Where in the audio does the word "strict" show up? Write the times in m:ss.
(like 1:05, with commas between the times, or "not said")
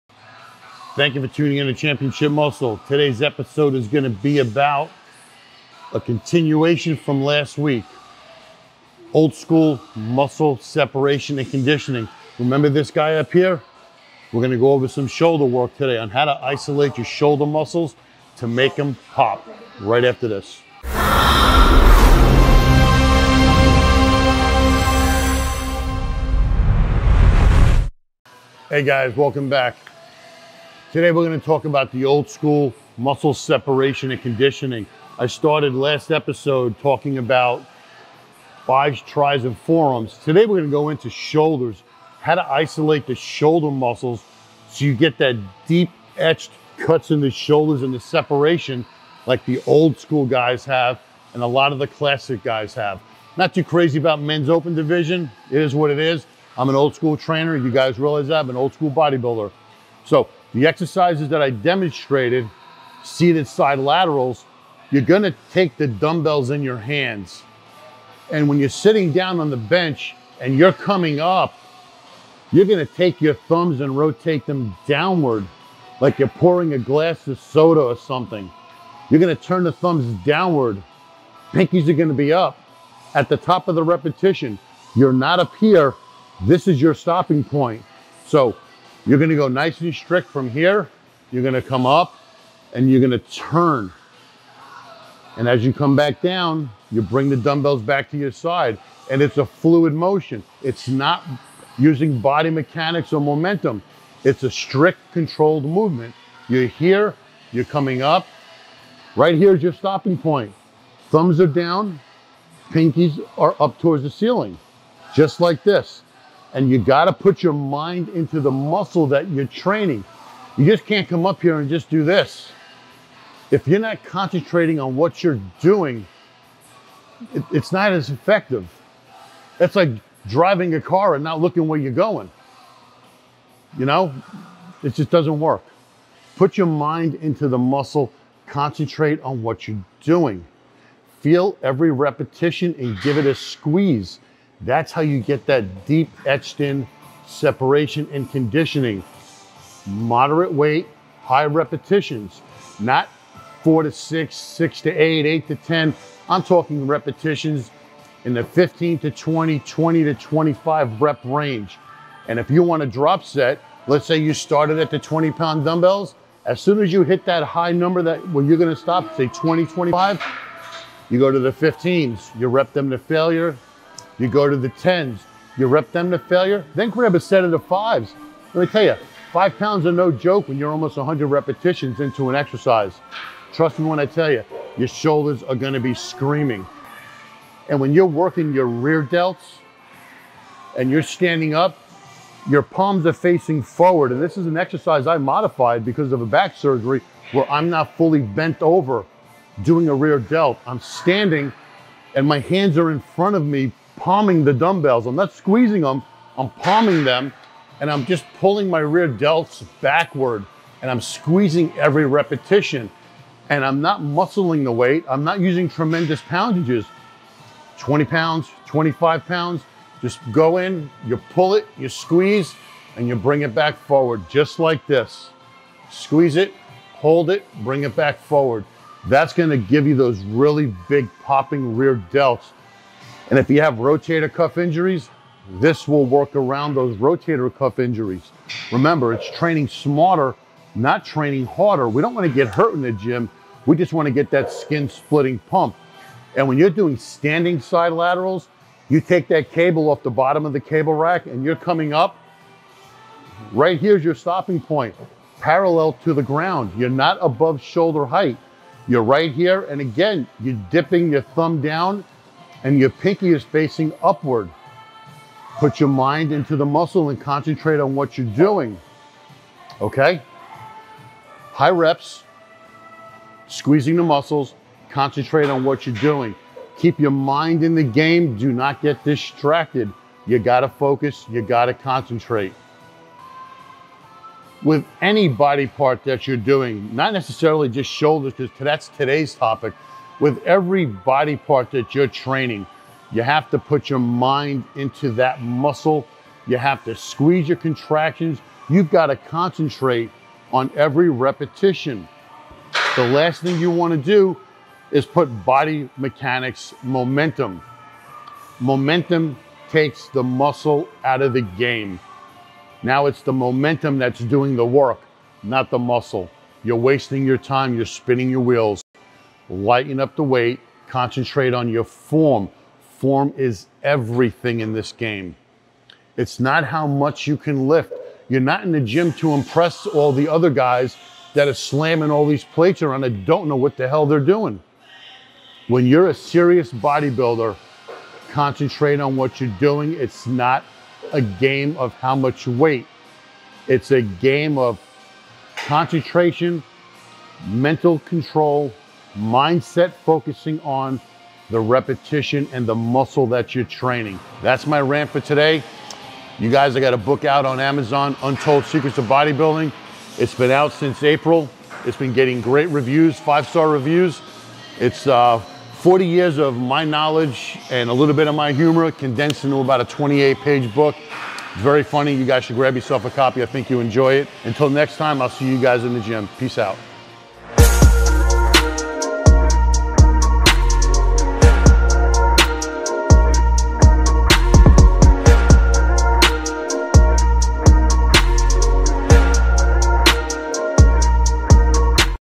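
1:29, 1:44.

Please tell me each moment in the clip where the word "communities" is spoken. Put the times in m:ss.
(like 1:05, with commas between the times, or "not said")
not said.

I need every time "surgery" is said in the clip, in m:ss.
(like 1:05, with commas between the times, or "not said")
3:16.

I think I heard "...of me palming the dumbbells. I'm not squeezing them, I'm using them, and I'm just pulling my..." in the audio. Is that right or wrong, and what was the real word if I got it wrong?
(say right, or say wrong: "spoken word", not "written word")
wrong: "palming", not "using".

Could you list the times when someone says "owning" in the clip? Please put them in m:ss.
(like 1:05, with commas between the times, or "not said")
not said.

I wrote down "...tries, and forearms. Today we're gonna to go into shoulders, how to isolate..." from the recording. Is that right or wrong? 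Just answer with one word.
right.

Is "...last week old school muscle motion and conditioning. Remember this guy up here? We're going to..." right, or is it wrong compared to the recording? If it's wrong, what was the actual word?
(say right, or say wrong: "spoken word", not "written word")
wrong: "separation", not "motion".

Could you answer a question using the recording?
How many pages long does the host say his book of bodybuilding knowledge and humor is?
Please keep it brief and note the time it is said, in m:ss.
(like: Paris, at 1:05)
28, at 6:09.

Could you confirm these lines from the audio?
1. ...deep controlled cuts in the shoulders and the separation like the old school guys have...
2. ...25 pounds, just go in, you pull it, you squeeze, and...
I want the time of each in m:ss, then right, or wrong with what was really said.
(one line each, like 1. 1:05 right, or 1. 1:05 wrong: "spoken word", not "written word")
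1. 0:45 wrong: "etched", not "controlled"
2. 3:38 right.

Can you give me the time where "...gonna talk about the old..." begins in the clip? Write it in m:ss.
0:31.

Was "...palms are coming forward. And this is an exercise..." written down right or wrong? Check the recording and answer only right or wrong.
wrong.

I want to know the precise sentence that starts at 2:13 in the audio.
You know, it just doesn't work.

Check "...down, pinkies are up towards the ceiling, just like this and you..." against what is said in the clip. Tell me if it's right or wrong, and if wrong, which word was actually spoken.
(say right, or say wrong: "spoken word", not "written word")
right.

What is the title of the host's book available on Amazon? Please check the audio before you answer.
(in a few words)
Untold Secrets of Bodybuilding.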